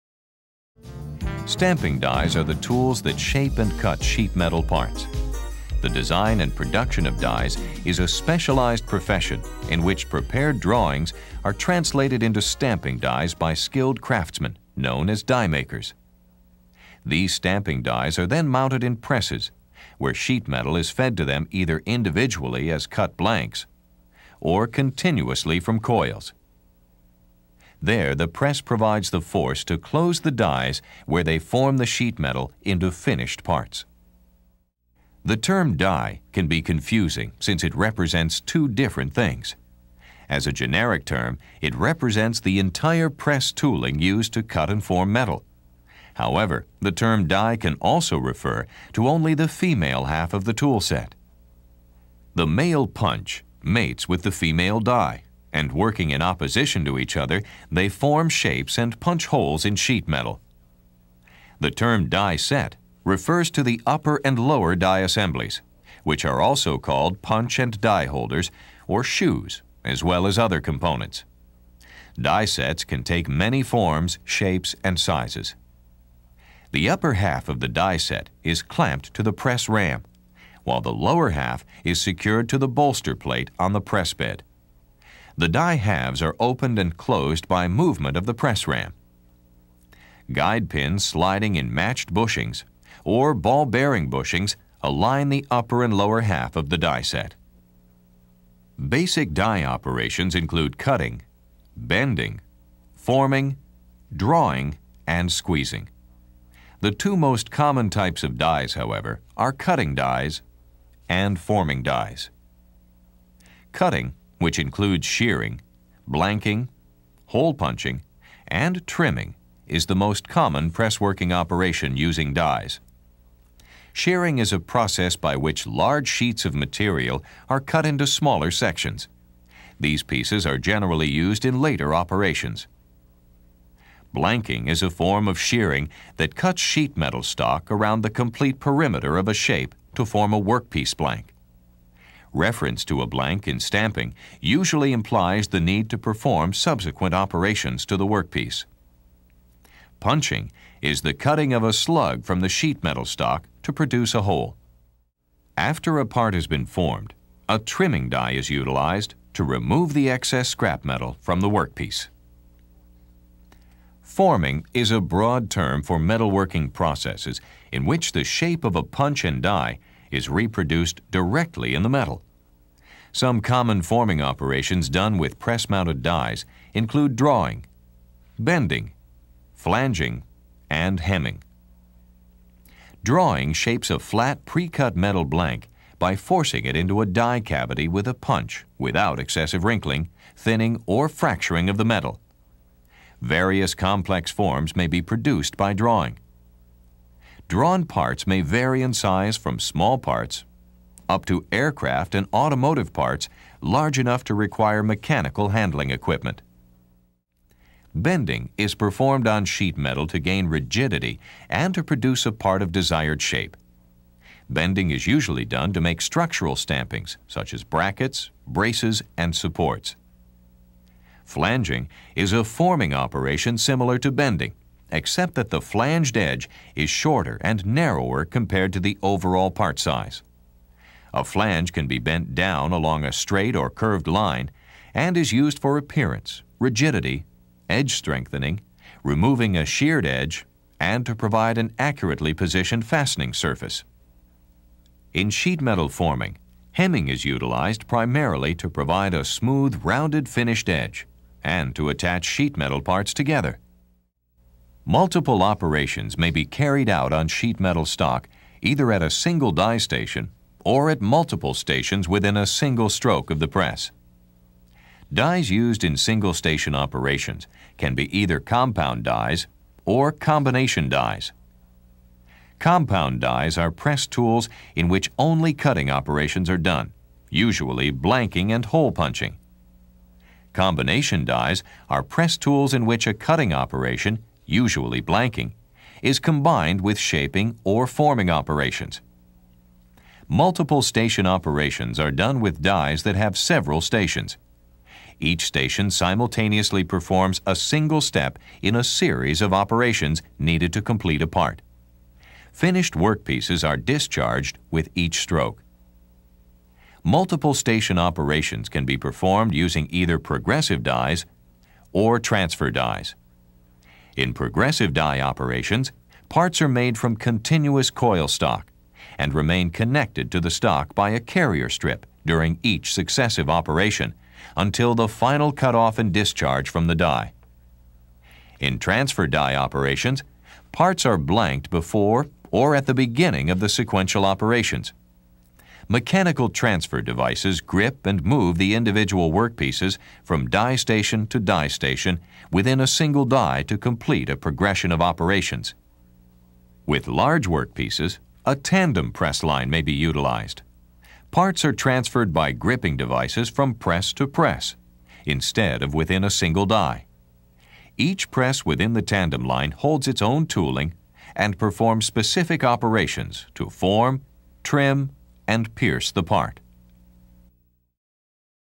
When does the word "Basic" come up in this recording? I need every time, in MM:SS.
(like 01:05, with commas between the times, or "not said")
01:38.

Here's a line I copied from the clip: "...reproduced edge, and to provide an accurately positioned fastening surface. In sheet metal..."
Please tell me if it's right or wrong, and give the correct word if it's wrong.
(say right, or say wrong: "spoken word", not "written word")
wrong: "sheared", not "reproduced".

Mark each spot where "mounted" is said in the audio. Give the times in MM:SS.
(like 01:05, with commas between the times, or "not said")
00:18, 02:55.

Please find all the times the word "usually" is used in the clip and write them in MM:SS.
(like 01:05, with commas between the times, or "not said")
02:24, 03:35, 04:37, 04:44.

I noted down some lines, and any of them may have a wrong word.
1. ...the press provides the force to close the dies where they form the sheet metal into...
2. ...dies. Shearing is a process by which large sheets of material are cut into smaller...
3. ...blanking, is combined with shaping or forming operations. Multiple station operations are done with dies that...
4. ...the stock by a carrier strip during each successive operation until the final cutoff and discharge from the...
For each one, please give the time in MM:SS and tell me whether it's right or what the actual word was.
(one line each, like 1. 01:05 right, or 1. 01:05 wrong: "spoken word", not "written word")
1. 00:28 right
2. 02:02 right
3. 04:45 right
4. 05:20 right.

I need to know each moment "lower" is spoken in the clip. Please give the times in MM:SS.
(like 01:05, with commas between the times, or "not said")
01:04, 01:20, 01:35.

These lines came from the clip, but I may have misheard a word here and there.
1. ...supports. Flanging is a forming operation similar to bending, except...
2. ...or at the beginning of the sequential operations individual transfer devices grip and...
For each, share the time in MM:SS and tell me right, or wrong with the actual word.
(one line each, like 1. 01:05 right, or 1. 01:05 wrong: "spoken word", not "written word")
1. 03:39 right
2. 05:32 wrong: "mechanical", not "individual".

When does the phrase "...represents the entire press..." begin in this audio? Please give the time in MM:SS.
00:41.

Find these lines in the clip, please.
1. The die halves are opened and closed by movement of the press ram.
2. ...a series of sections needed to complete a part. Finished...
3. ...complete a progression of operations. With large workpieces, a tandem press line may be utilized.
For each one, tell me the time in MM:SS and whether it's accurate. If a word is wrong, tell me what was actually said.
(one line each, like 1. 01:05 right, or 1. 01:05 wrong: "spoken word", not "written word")
1. 01:25 right
2. 04:58 wrong: "operations", not "sections"
3. 05:43 right.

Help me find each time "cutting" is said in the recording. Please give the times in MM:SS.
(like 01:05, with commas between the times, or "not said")
01:40, 01:49, 01:53, 02:31, 04:35, 04:43.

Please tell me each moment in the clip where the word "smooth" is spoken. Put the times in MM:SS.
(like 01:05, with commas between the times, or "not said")
04:09.